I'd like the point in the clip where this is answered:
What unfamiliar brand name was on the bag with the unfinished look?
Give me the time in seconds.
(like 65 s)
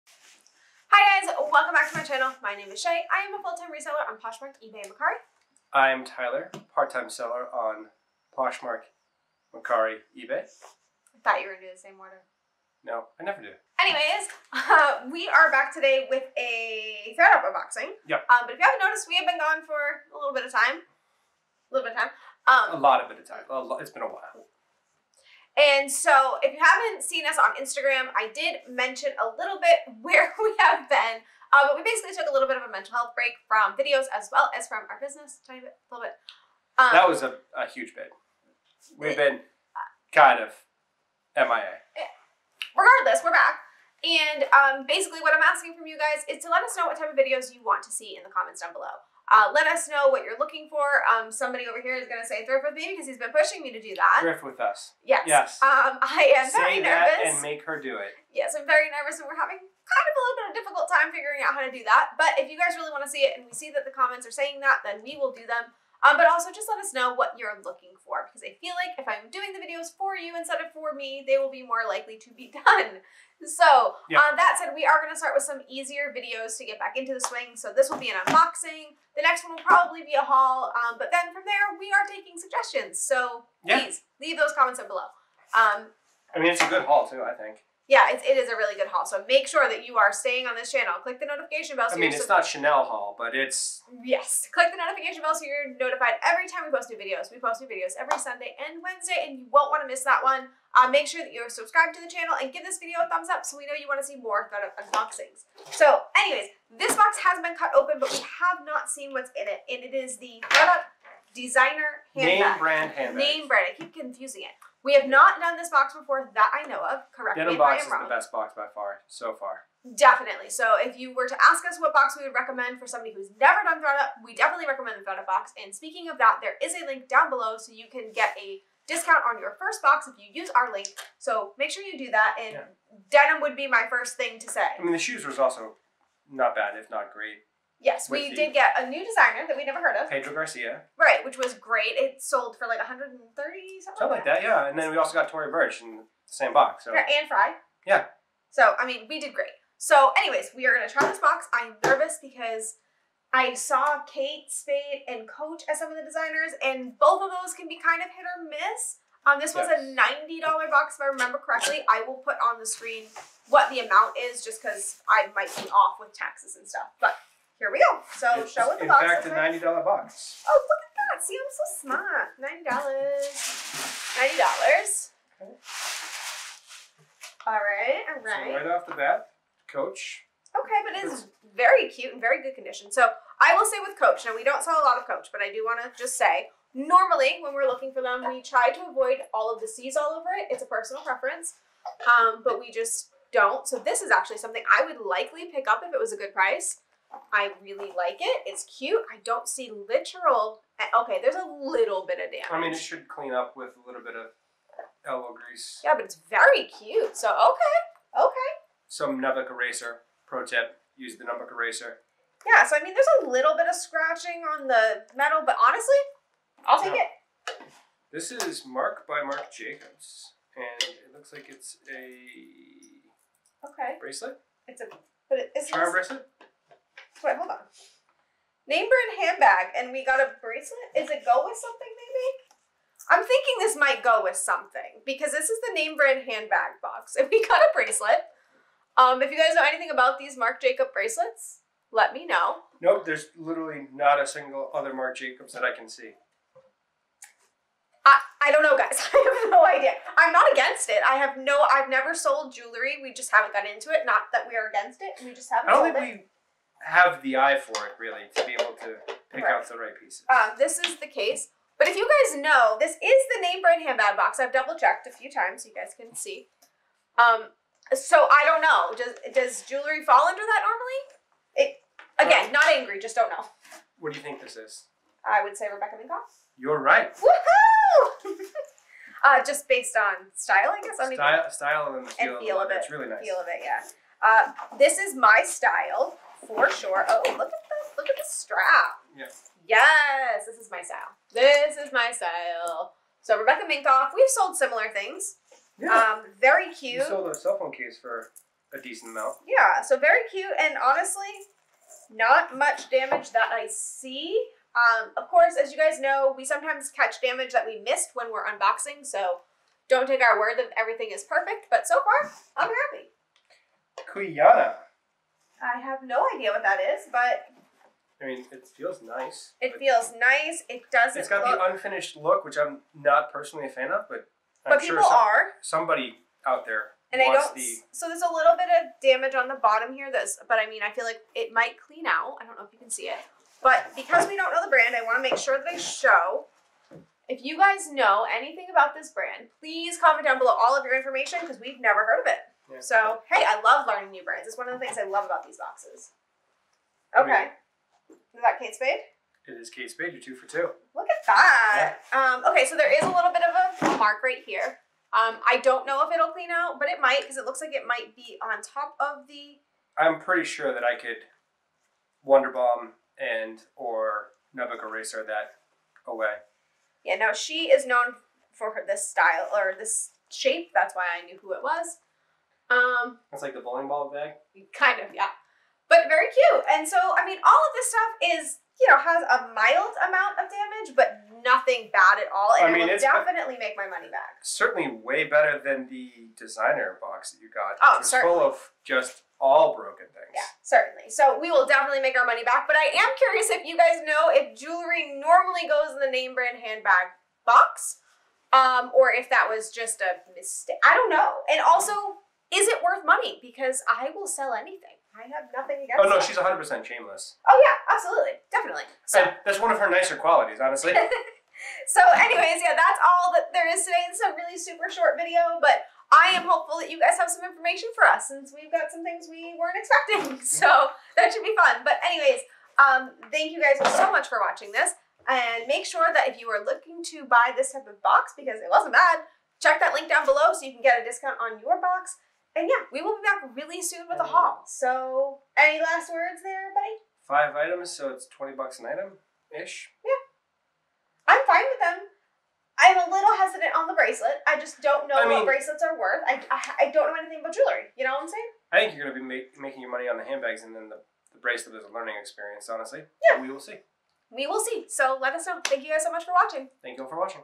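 314 s.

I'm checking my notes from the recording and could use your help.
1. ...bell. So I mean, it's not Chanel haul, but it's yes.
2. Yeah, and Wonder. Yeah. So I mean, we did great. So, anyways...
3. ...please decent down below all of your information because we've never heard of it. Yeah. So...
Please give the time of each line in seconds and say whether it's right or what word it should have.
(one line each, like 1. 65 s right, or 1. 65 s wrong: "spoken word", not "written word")
1. 91 s right
2. 146 s wrong: "Frye", not "Wonder"
3. 339 s wrong: "comment", not "decent".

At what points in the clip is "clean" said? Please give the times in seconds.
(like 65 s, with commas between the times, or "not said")
203 s, 331 s, 356 s.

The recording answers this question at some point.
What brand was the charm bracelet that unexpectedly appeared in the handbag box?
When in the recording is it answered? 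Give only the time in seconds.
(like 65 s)
218 s.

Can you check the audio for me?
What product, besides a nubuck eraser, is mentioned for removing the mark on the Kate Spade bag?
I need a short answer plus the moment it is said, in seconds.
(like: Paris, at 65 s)
Wonder Bomb, at 362 s.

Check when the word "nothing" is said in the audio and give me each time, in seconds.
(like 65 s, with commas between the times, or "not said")
381 s, 405 s.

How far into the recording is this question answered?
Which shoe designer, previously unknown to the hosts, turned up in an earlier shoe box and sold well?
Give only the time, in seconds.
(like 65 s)
140 s.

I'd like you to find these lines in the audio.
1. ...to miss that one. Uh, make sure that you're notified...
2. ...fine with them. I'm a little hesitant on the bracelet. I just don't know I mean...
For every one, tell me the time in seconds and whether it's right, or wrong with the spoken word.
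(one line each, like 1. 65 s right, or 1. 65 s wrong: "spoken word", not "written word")
1. 99 s wrong: "subscribed", not "notified"
2. 441 s right.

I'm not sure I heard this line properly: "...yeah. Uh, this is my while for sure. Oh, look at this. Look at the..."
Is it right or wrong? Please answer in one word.
wrong.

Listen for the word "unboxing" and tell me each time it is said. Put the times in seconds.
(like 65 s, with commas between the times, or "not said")
17 s, 78 s, 104 s, 308 s.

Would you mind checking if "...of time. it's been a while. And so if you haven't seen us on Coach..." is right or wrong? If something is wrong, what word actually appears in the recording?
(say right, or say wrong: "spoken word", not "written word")
wrong: "Instagram", not "Coach".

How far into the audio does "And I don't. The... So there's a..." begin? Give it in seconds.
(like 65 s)
327 s.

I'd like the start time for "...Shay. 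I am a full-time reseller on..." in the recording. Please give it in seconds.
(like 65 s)
2 s.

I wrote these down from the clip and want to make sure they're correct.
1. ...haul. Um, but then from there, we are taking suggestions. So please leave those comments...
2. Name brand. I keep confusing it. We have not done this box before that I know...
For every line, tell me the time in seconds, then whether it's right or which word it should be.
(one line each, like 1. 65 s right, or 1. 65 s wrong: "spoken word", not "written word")
1. 80 s right
2. 113 s right.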